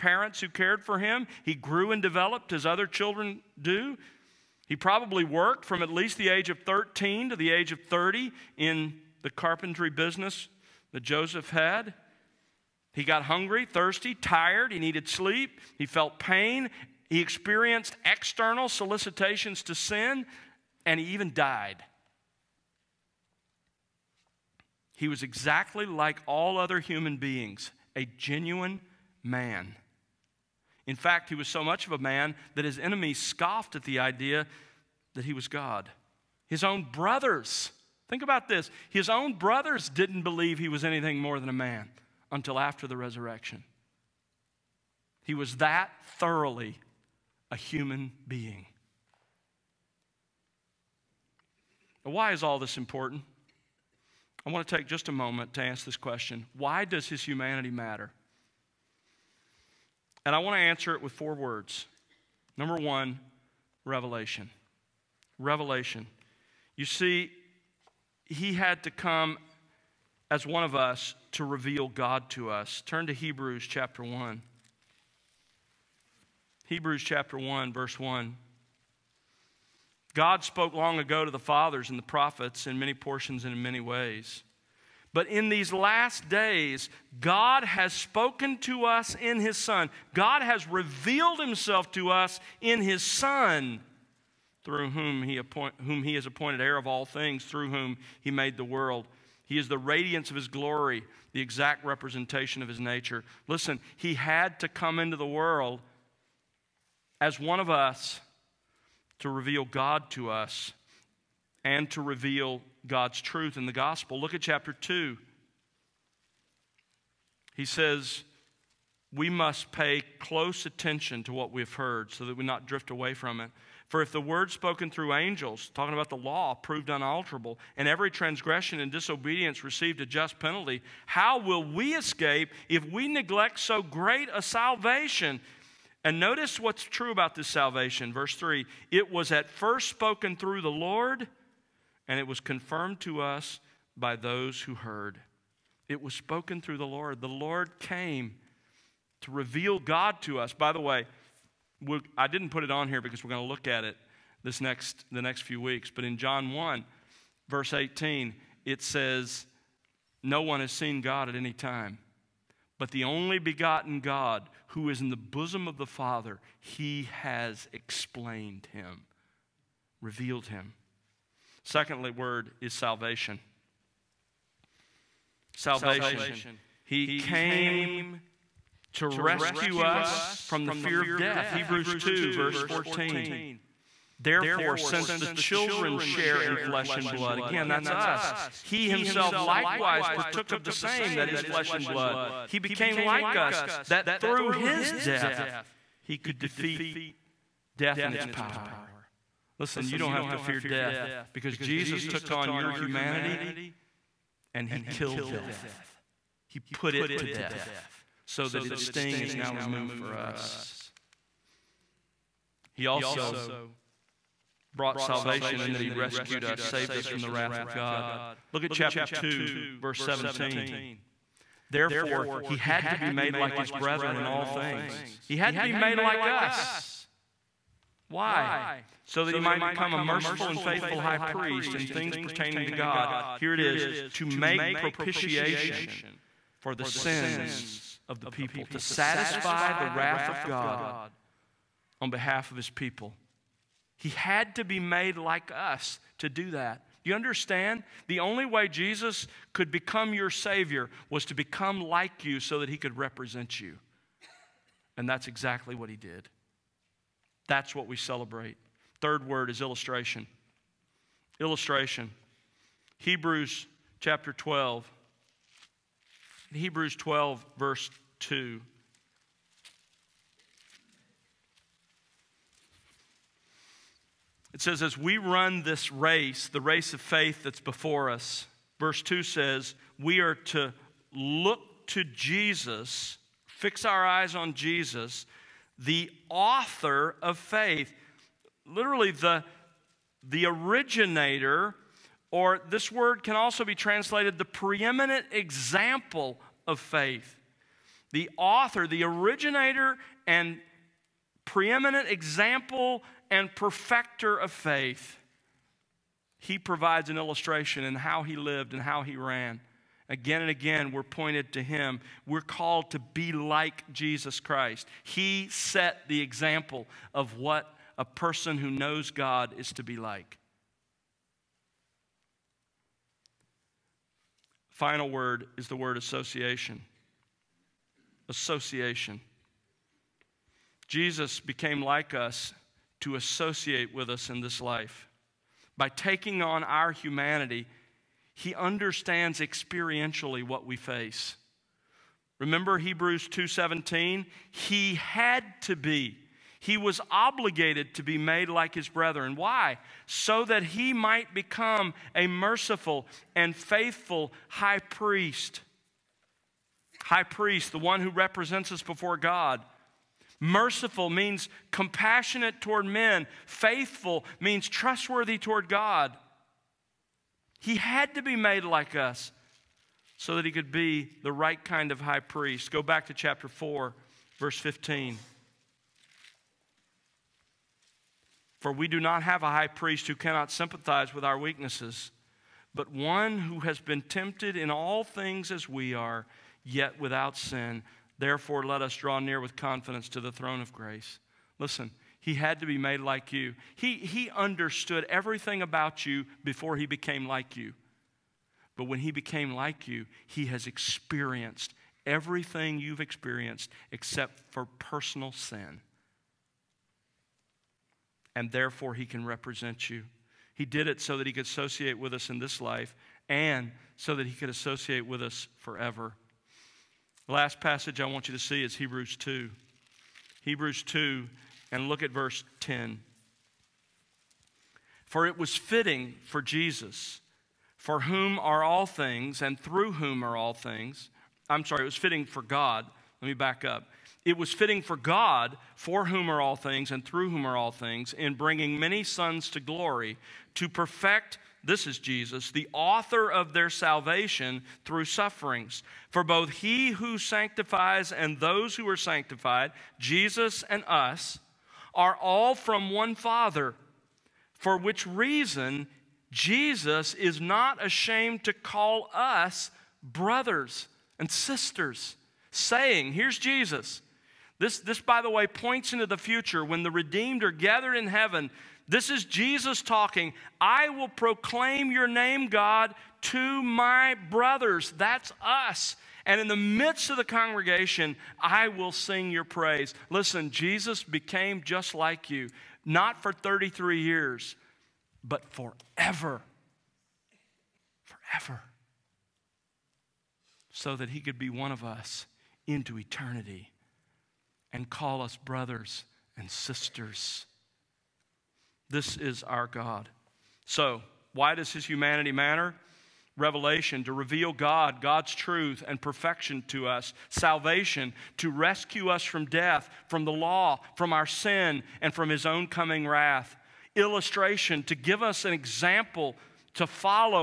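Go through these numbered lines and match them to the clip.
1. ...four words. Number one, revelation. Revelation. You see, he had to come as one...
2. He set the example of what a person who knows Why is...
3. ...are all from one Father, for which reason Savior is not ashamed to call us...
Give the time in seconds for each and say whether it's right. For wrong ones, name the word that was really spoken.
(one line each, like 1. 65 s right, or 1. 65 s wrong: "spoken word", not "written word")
1. 61 s right
2. 315 s wrong: "God", not "Why"
3. 451 s wrong: "Jesus", not "Savior".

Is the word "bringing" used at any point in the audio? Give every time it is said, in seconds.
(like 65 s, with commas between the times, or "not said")
438 s.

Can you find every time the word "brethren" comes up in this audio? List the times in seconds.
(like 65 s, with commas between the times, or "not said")
223 s, 348 s.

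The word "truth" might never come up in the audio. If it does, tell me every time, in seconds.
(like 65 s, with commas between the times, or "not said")
113 s, 505 s.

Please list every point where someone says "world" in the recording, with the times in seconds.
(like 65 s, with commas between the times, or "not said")
98 s, 105 s.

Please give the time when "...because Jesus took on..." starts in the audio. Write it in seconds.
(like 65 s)
201 s.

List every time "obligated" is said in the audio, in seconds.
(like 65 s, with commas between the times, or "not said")
347 s.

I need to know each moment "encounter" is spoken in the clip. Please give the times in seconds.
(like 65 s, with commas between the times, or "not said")
not said.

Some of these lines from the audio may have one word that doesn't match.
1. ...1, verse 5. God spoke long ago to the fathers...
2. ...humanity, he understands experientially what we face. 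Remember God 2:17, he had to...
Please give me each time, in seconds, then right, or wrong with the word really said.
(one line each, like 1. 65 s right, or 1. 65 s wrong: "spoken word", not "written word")
1. 77 s wrong: "1", not "5"
2. 336 s wrong: "Hebrews", not "God".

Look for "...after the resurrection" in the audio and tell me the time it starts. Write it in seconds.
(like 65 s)
42 s.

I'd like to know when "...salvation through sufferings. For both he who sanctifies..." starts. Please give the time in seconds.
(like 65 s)
443 s.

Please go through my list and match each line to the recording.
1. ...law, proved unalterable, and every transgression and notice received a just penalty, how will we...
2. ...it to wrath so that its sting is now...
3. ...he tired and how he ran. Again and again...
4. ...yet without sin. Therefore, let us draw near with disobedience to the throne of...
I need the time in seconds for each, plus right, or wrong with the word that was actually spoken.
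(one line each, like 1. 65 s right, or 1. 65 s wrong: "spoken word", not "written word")
1. 126 s wrong: "disobedience", not "notice"
2. 206 s wrong: "death", not "wrath"
3. 308 s wrong: "lived", not "tired"
4. 386 s wrong: "confidence", not "disobedience".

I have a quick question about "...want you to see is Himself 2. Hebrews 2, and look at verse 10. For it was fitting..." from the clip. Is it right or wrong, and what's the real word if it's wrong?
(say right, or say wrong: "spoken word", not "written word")
wrong: "Hebrews", not "Himself".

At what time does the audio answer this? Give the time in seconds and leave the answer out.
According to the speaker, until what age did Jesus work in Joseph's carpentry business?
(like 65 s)
7 s.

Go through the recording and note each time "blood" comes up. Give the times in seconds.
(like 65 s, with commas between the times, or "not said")
187 s, 191 s.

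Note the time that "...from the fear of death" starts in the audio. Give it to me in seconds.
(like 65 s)
180 s.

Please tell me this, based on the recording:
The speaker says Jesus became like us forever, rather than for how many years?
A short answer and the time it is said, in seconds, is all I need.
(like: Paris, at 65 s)
33, at 483 s.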